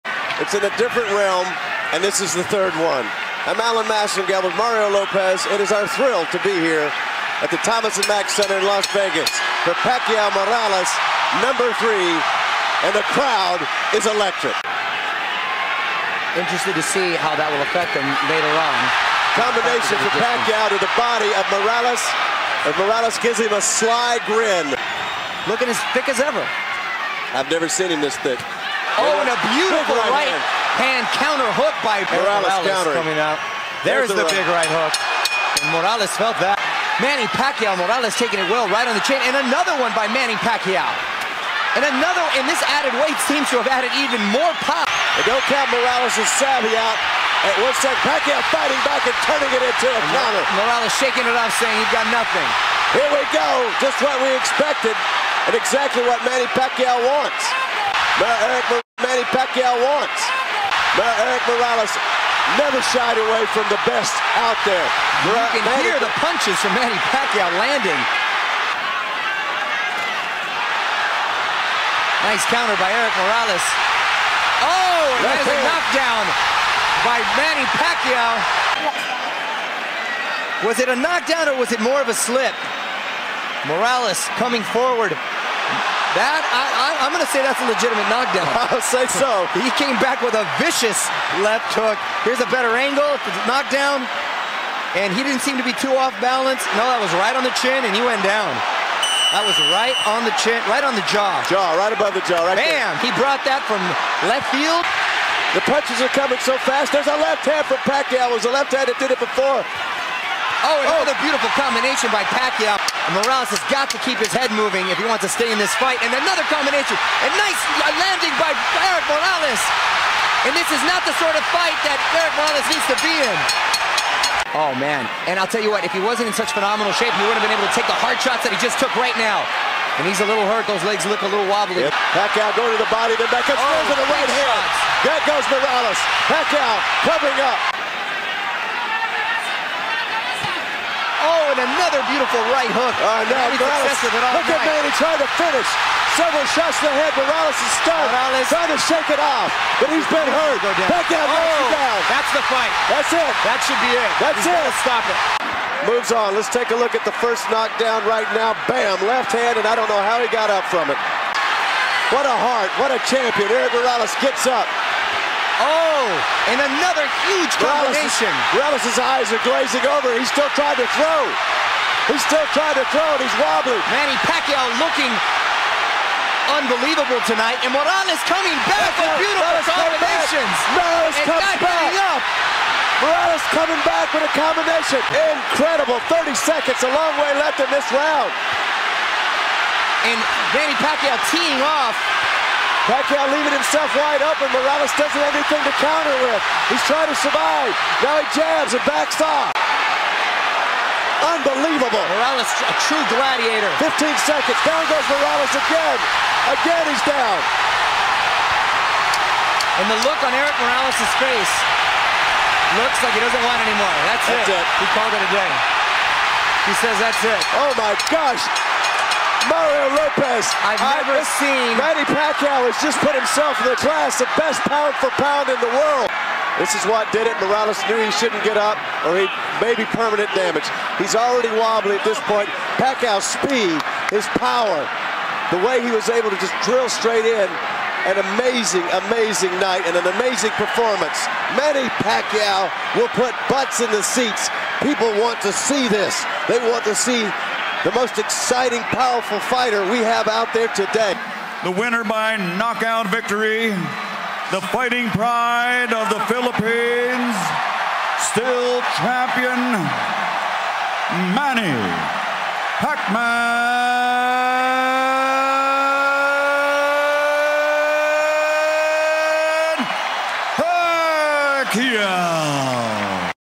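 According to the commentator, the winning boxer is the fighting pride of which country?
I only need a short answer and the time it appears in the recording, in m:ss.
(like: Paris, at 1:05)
the Philippines, at 4:16.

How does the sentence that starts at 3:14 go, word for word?
Morales doesn't have anything to counter with.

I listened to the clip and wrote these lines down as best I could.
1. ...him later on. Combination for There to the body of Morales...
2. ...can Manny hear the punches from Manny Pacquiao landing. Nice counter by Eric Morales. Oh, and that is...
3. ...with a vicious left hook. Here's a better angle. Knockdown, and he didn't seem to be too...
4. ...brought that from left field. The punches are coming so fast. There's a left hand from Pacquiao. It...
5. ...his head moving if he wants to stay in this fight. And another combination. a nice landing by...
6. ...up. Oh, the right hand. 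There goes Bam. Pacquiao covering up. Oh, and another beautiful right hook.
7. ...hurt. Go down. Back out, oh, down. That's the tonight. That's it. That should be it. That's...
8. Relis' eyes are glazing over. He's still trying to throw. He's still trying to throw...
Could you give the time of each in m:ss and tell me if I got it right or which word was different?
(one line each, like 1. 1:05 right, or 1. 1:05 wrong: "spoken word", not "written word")
1. 0:17 wrong: "Pacquiao", not "There"
2. 1:05 right
3. 1:30 right
4. 1:43 right
5. 1:54 right
6. 2:13 wrong: "Morales", not "Bam"
7. 2:30 wrong: "fight", not "tonight"
8. 2:48 right.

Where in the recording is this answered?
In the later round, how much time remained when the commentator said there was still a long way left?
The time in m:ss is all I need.
3:06.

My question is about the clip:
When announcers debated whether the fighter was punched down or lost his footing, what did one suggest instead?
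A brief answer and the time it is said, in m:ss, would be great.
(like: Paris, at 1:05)
a slip, at 1:22.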